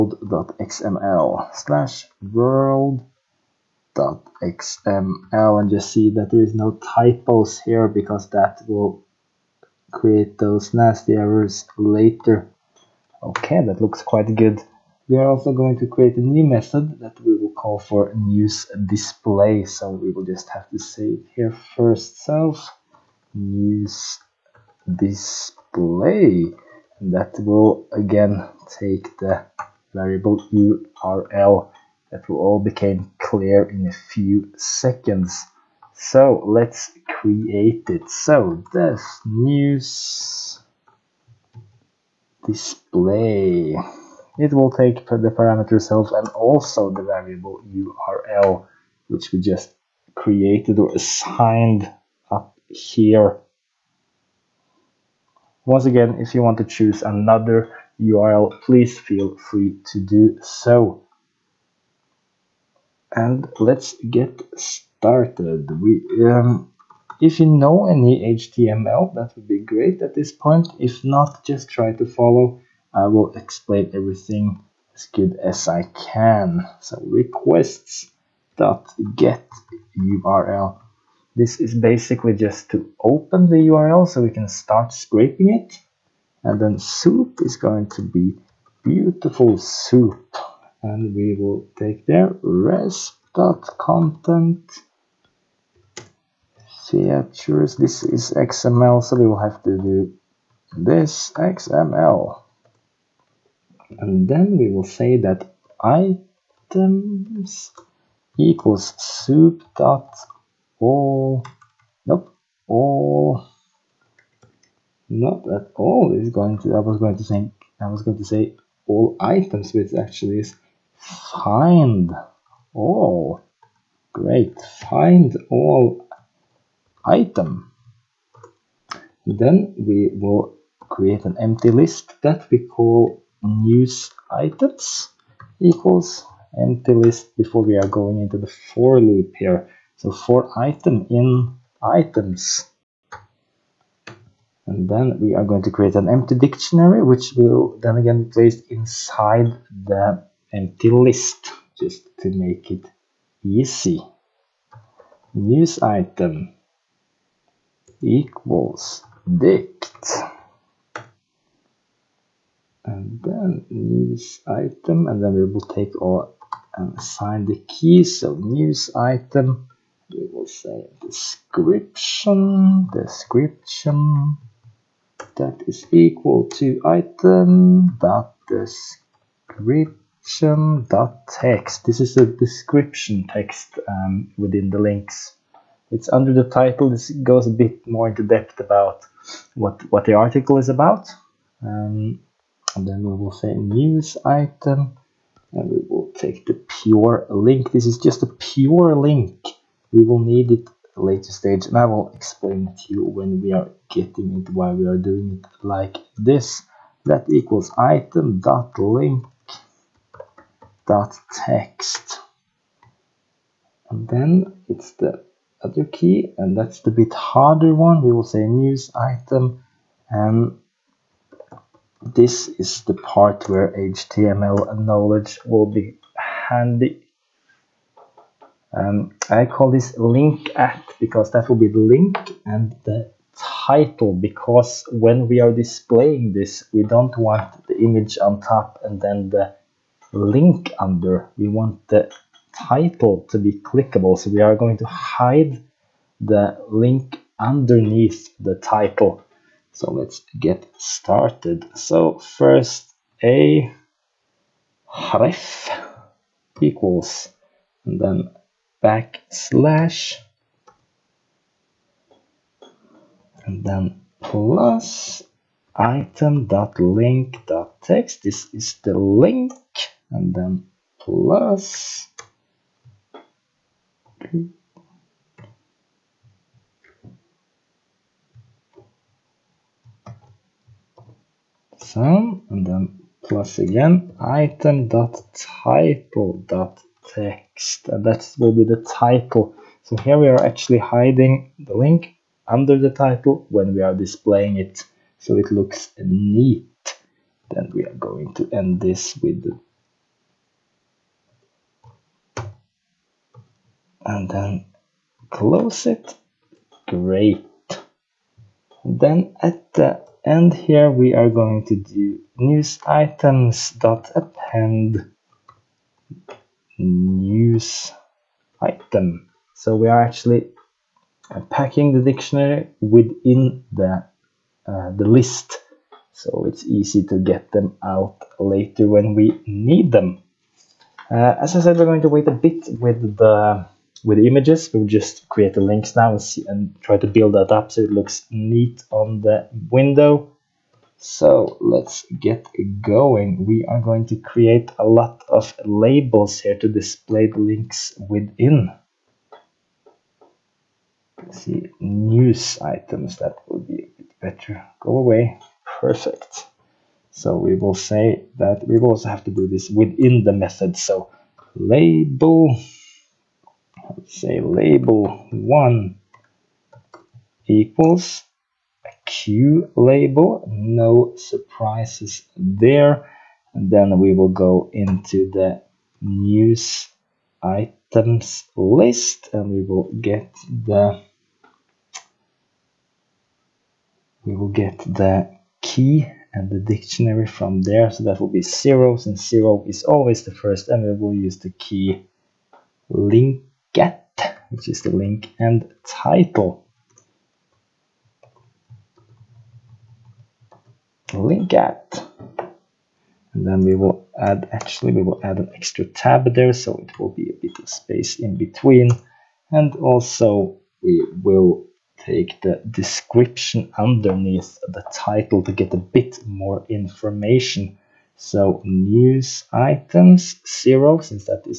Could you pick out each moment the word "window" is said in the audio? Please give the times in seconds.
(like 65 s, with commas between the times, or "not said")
339 s.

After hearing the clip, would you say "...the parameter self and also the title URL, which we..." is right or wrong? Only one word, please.
wrong.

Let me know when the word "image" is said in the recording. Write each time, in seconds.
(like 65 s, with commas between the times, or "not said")
237 s, 334 s.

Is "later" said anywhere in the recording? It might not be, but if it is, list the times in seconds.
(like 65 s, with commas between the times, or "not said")
11 s, 201 s, 328 s.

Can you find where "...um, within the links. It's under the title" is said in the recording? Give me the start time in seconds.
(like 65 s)
183 s.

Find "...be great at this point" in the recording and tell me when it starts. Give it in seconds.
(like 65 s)
69 s.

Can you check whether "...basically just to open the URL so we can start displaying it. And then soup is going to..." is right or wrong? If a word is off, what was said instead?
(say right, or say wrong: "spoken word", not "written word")
wrong: "scraping", not "displaying".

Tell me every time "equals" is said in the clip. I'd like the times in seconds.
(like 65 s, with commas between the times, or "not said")
108 s, 135 s, 158 s, 175 s, 207 s, 256 s, 367 s.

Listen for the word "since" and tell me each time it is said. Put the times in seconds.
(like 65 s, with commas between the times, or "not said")
388 s, 420 s.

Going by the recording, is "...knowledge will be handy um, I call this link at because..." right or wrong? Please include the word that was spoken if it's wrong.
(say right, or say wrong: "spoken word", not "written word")
right.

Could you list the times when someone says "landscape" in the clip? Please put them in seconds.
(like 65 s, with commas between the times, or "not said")
not said.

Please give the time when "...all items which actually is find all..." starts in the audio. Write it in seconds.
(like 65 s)
118 s.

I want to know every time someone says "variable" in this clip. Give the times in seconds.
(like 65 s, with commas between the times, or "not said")
29 s, 47 s.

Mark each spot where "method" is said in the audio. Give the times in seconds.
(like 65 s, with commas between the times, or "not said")
16 s, 360 s.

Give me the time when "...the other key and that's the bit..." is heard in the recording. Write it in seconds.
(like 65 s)
214 s.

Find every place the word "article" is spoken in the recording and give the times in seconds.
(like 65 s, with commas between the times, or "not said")
190 s.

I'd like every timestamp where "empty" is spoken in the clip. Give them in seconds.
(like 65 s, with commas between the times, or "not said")
131 s, 136 s, 146 s, 150 s.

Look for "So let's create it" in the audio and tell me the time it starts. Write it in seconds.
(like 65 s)
35 s.